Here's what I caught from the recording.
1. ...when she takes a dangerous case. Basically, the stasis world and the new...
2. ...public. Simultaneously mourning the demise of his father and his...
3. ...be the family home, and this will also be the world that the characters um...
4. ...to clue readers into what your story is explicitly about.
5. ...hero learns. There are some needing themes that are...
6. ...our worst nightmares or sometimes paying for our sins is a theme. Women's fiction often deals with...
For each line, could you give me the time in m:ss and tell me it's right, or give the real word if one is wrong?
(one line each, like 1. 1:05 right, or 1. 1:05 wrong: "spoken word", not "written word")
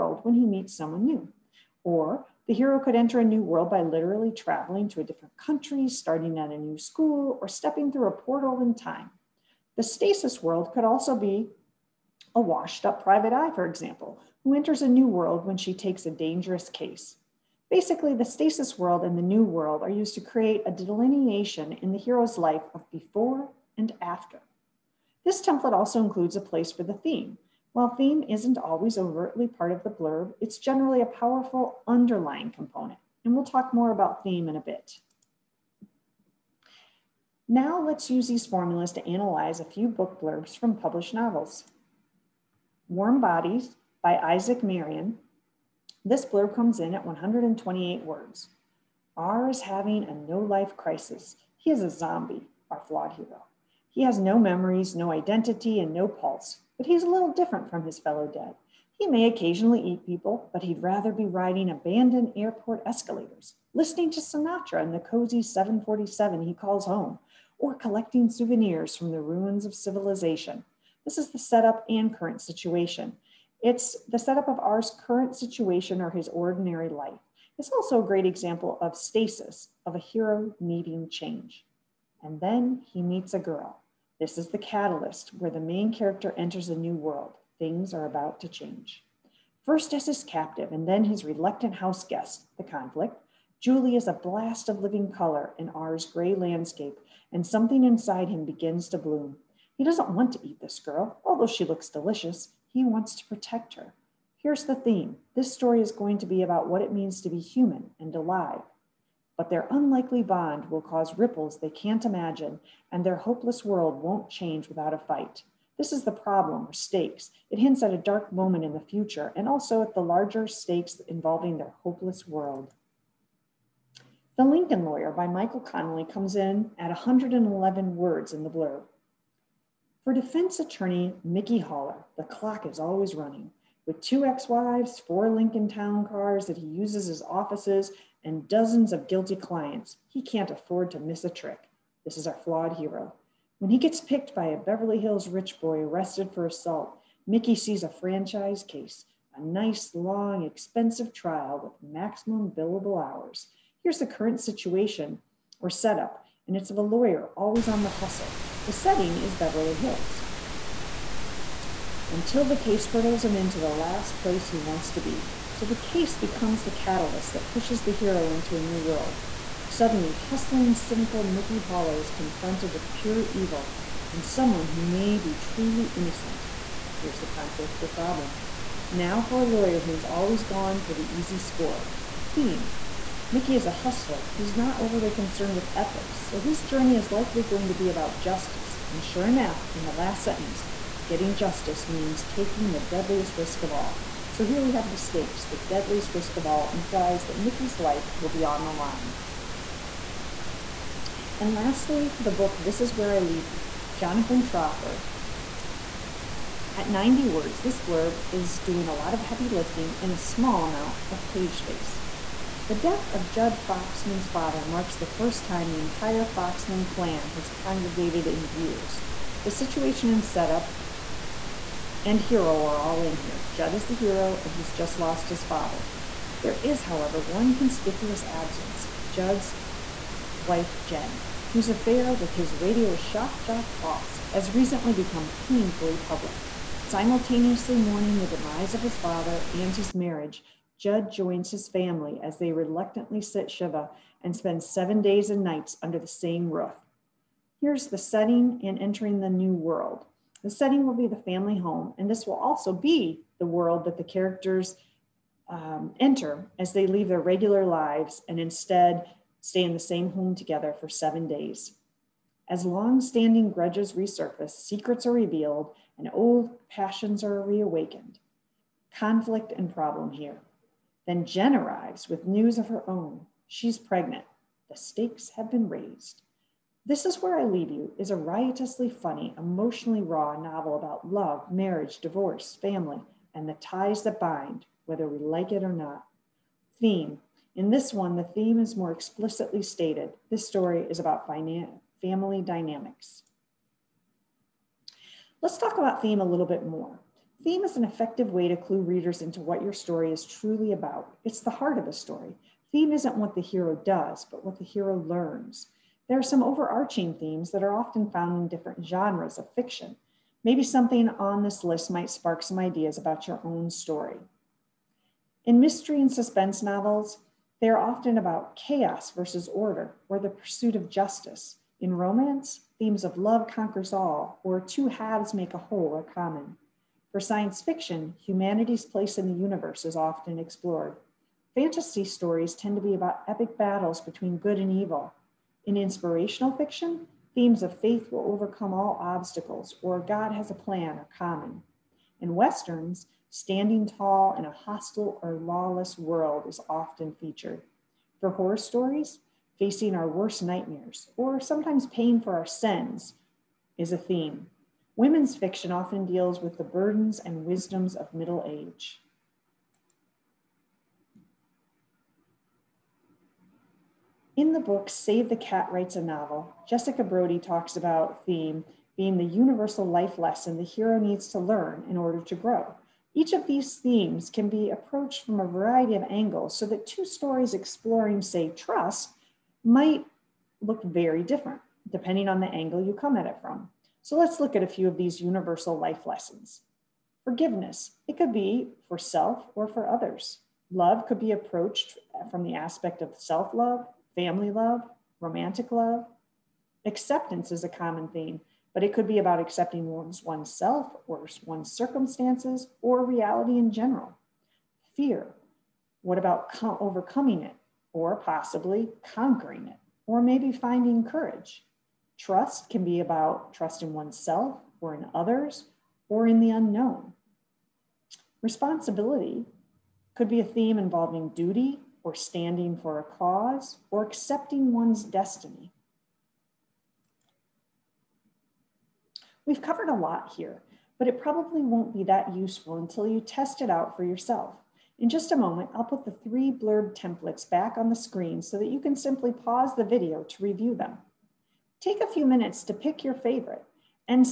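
1. 0:15 right
2. 3:55 right
3. 4:10 right
4. 4:58 wrong: "truly", not "explicitly"
5. 5:04 wrong: "overarching", not "needing"
6. 5:49 right.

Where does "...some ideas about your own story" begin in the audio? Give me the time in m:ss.
5:12.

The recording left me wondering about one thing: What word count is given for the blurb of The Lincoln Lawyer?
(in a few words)
111.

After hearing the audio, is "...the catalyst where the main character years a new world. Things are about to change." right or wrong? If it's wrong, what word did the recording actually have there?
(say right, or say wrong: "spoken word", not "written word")
wrong: "enters", not "years".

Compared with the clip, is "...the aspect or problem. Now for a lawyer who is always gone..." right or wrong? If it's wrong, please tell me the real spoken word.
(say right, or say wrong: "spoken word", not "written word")
wrong: "conflict", not "aspect".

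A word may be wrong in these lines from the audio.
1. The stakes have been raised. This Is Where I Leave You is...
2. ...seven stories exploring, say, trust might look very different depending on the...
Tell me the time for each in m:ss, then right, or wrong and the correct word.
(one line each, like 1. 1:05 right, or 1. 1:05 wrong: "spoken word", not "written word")
1. 4:34 right
2. 6:16 wrong: "two", not "seven".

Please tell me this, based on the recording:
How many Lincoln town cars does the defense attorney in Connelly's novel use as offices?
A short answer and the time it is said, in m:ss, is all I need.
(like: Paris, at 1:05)
four, at 2:14.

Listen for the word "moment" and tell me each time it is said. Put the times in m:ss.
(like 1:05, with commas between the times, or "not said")
1:58, 7:15.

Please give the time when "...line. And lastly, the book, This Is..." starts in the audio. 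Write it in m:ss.
3:18.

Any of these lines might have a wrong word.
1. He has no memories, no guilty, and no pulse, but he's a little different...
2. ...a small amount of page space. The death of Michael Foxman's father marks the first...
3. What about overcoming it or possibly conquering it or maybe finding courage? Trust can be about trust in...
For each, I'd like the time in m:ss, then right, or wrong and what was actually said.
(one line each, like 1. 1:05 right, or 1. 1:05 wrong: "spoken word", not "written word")
1. 0:53 wrong: "identity", not "guilty"
2. 3:30 wrong: "Judd", not "Michael"
3. 6:46 right.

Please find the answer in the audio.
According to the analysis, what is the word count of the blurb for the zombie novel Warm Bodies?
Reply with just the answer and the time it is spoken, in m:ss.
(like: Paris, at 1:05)
128, at 0:47.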